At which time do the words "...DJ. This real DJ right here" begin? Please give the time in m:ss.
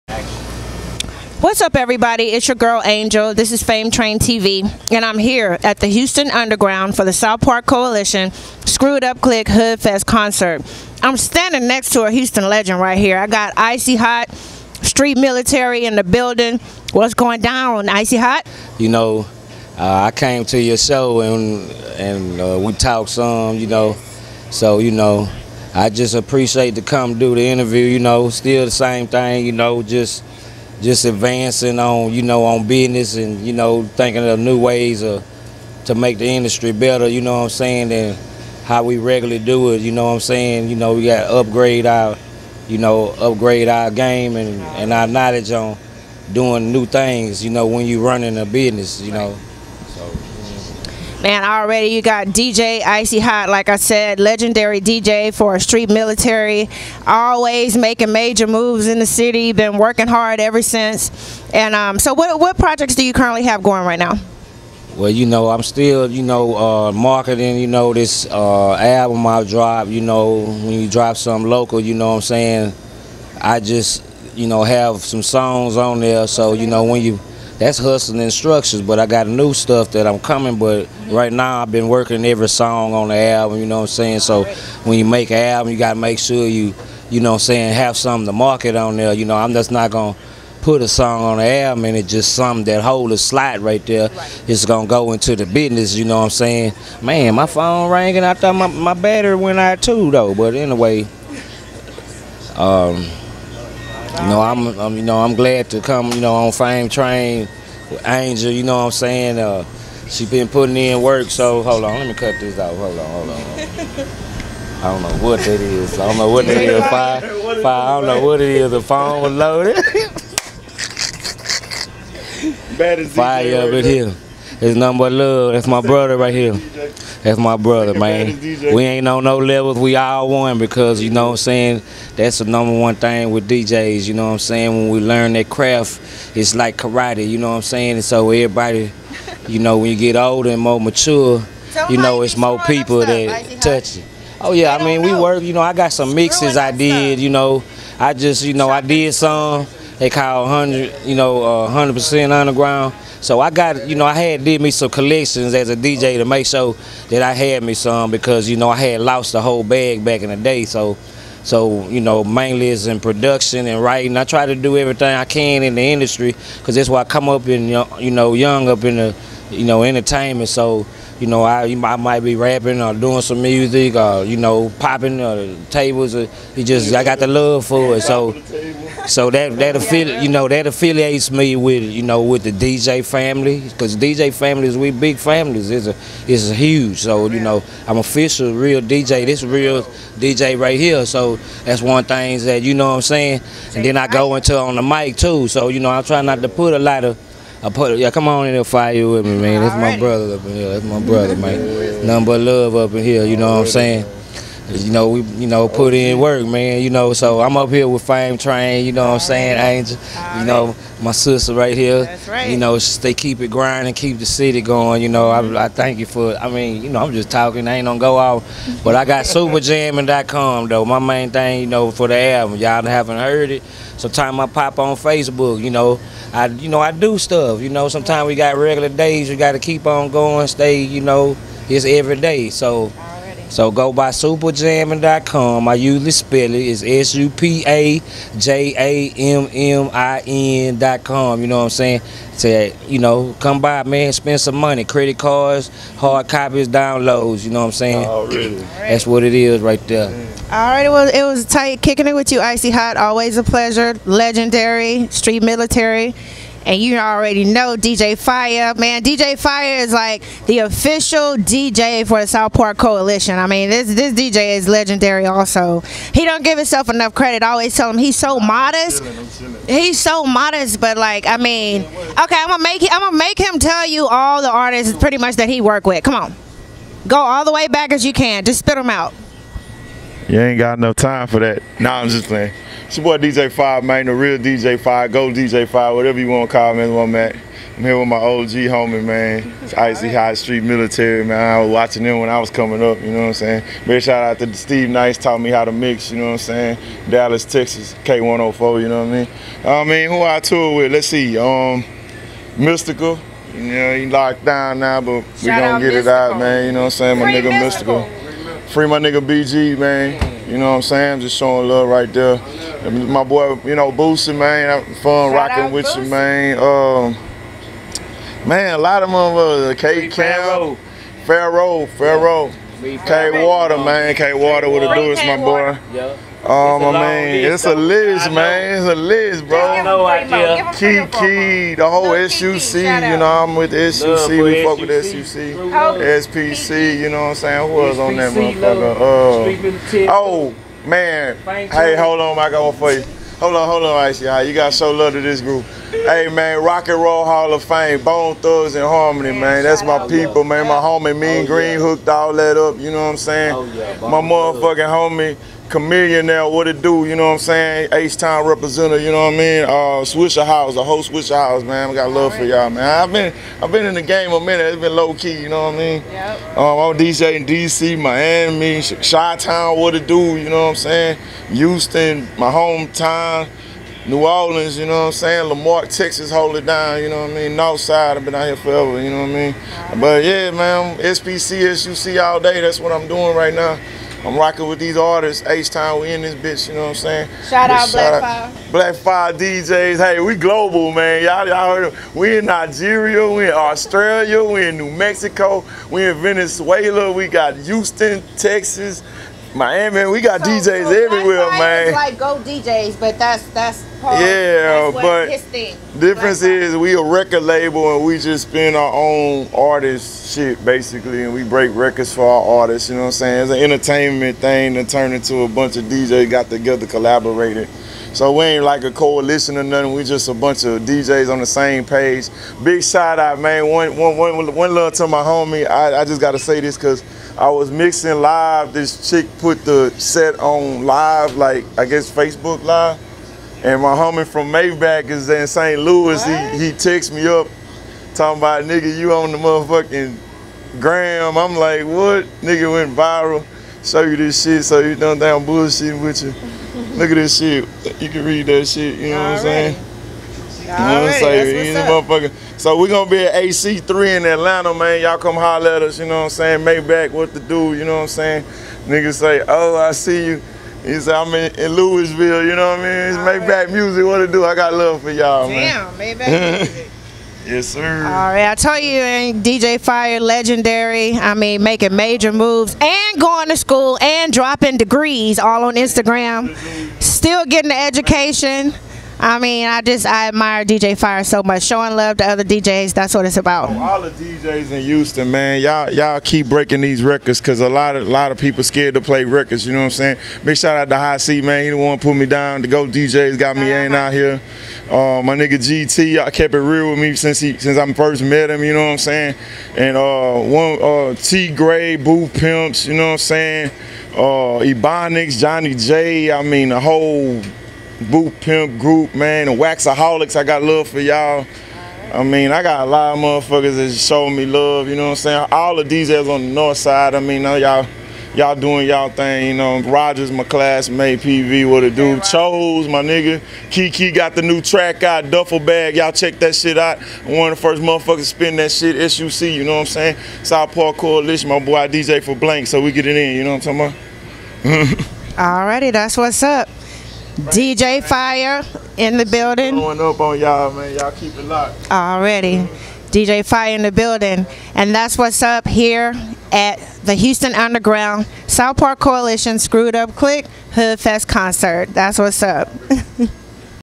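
3:08.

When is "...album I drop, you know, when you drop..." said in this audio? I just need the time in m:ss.
1:08.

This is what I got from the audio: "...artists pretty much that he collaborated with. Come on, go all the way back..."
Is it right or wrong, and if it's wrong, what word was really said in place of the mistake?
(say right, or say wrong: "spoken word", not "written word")
wrong: "worked", not "collaborated".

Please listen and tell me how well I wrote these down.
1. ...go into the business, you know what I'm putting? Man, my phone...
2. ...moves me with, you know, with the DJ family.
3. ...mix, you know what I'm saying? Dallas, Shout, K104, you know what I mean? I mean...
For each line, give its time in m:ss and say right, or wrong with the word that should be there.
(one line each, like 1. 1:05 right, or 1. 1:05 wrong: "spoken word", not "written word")
1. 1:34 wrong: "saying", not "putting"
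2. 3:00 wrong: "affiliates", not "moves"
3. 4:55 wrong: "Texas", not "Shout".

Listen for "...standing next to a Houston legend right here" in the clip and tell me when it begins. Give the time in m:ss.
0:11.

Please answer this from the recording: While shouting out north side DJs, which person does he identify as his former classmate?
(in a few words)
Rogers.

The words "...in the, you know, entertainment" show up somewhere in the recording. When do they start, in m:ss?
2:48.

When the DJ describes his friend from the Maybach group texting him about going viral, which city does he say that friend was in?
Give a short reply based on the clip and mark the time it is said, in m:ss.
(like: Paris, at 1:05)
St. Louis, at 7:15.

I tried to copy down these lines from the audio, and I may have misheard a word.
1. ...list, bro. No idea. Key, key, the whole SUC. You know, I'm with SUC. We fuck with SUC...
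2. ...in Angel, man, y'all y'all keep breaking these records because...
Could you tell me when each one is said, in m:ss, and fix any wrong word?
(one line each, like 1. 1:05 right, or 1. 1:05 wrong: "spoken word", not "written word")
1. 5:28 right
2. 8:04 wrong: "Houston", not "Angel".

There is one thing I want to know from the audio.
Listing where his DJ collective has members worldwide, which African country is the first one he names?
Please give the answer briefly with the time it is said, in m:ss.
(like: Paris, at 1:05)
Nigeria, at 6:32.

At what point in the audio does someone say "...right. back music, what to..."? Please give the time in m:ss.
7:43.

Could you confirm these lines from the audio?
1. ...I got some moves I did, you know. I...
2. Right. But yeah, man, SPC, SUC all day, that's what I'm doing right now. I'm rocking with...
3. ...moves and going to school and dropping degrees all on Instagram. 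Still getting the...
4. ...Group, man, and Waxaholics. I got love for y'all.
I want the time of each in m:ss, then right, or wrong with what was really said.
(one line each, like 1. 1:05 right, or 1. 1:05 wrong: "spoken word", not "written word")
1. 2:25 wrong: "mixes", not "moves"
2. 6:19 right
3. 7:52 right
4. 8:28 right.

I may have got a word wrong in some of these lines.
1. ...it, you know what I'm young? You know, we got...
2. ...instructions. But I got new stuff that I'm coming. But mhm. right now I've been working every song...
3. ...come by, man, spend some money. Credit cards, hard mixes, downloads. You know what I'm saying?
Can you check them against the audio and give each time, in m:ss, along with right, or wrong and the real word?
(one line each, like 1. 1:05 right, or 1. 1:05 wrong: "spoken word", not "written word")
1. 0:39 wrong: "saying", not "young"
2. 1:18 right
3. 4:03 wrong: "copies", not "mixes".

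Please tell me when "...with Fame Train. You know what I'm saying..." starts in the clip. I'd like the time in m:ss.
3:27.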